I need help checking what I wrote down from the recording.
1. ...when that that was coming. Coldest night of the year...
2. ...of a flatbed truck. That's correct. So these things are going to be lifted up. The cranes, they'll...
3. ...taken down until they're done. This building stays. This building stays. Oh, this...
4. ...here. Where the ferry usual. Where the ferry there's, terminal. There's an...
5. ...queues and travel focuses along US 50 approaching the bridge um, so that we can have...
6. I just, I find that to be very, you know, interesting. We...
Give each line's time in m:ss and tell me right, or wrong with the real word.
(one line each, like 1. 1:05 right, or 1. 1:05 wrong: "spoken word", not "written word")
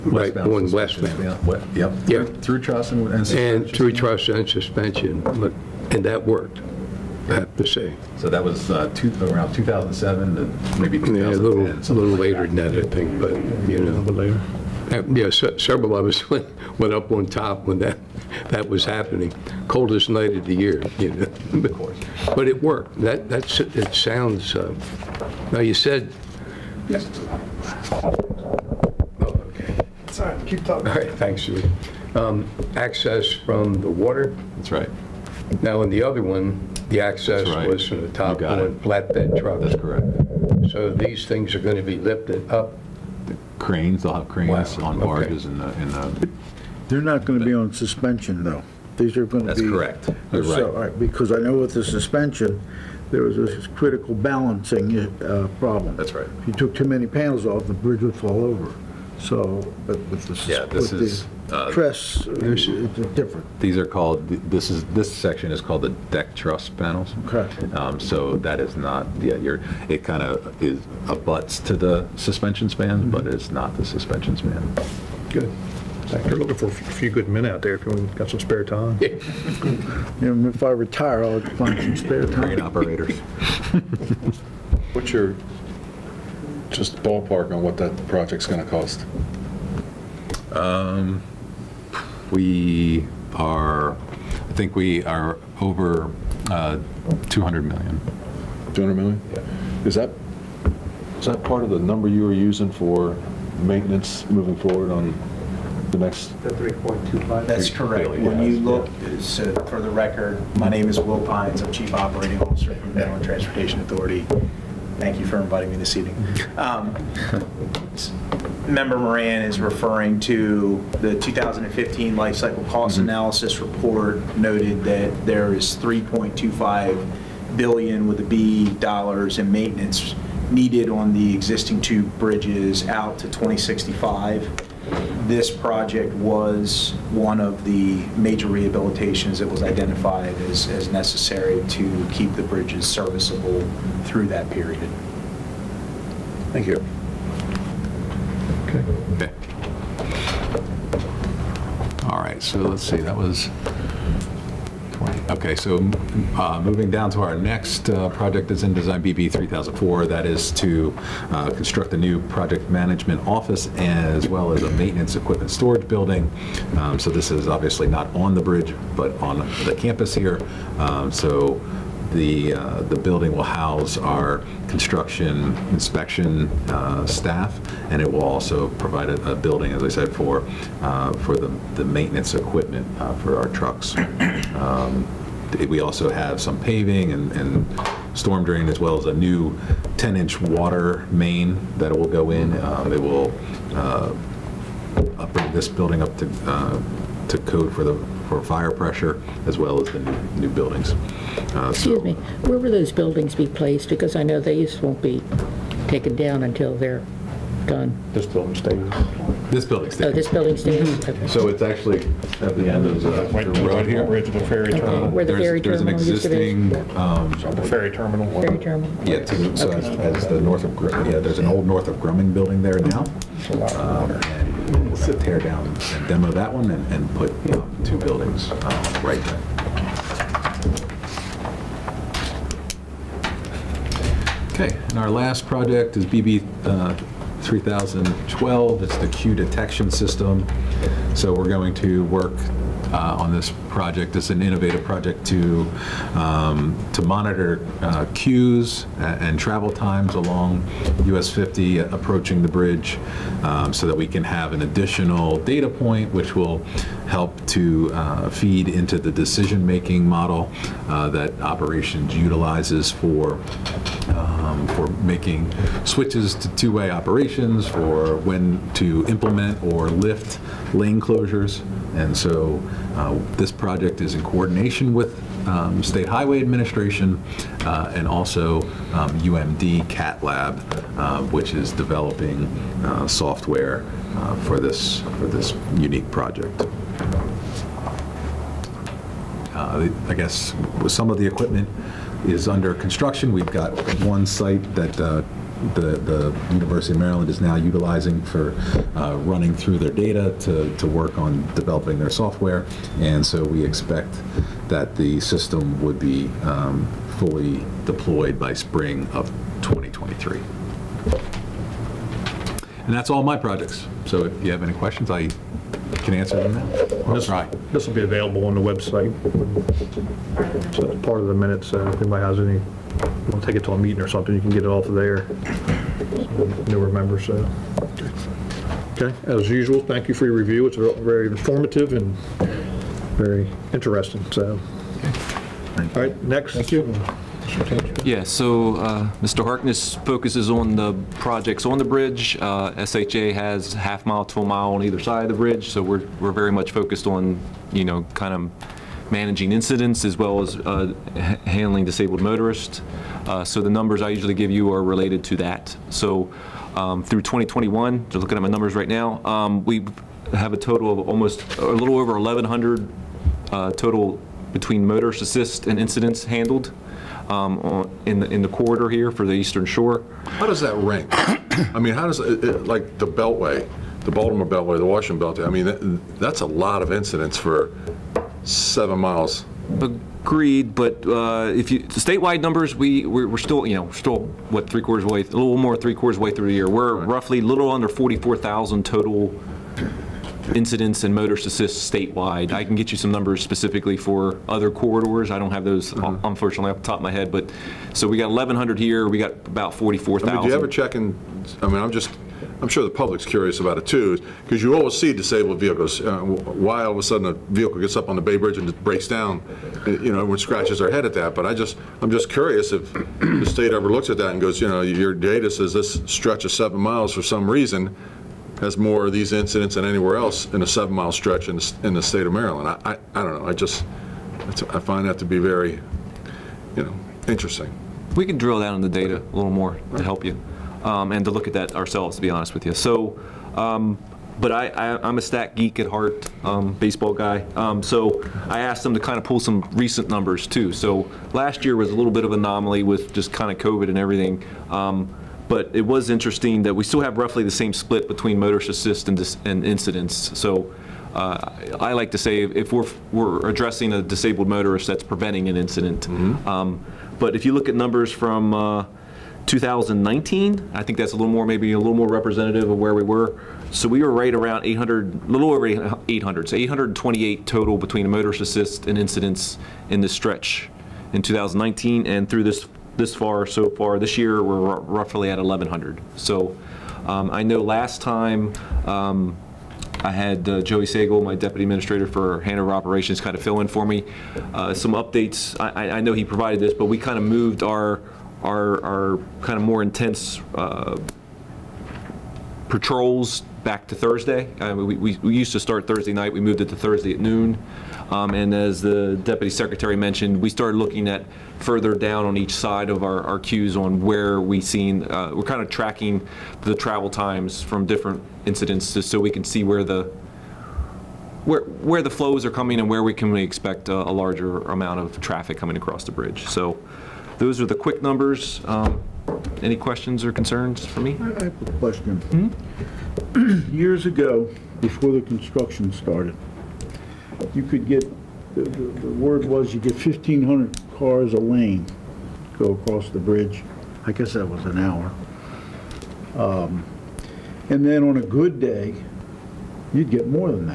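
1. 0:17 wrong: "happening", not "coming"
2. 0:38 right
3. 3:25 right
4. 3:33 wrong: "terminal", not "usual"
5. 4:08 wrong: "times", not "focuses"
6. 7:03 right.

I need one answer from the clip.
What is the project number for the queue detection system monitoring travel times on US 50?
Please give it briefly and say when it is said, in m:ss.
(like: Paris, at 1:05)
BB 3012, at 3:56.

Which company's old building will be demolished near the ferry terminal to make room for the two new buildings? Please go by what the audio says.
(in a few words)
Northrop Grumman.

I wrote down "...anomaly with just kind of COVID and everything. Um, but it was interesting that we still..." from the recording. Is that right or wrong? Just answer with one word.
right.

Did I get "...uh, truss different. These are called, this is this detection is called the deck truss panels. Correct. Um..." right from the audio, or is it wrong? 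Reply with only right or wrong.
wrong.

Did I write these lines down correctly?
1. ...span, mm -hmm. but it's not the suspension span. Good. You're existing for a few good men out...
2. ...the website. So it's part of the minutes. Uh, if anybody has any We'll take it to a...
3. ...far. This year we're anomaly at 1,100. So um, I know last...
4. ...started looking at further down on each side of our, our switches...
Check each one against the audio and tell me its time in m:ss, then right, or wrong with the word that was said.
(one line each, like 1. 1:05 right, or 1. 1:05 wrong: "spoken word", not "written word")
1. 1:12 wrong: "looking", not "existing"
2. 5:18 right
3. 7:53 wrong: "roughly", not "anomaly"
4. 8:20 wrong: "queues", not "switches".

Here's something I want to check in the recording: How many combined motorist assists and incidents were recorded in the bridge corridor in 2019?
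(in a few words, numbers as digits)
828.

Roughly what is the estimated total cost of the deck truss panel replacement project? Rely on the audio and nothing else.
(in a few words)
Over $200 million.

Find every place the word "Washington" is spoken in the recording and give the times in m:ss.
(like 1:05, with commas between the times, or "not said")
6:14.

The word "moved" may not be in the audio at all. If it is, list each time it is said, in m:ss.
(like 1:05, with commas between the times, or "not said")
8:07, 8:16.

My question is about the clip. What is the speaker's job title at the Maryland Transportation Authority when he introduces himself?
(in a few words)
Chief Operating Officer.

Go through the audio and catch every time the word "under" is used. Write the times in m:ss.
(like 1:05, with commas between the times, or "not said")
4:52, 6:27.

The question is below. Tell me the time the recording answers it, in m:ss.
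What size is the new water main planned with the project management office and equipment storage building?
3:09.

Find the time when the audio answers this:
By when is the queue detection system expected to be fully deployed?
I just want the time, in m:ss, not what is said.
5:08.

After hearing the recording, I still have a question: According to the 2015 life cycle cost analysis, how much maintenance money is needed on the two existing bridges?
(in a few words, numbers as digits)
$3.25 billion.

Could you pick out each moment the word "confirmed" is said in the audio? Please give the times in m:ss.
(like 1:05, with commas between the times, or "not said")
not said.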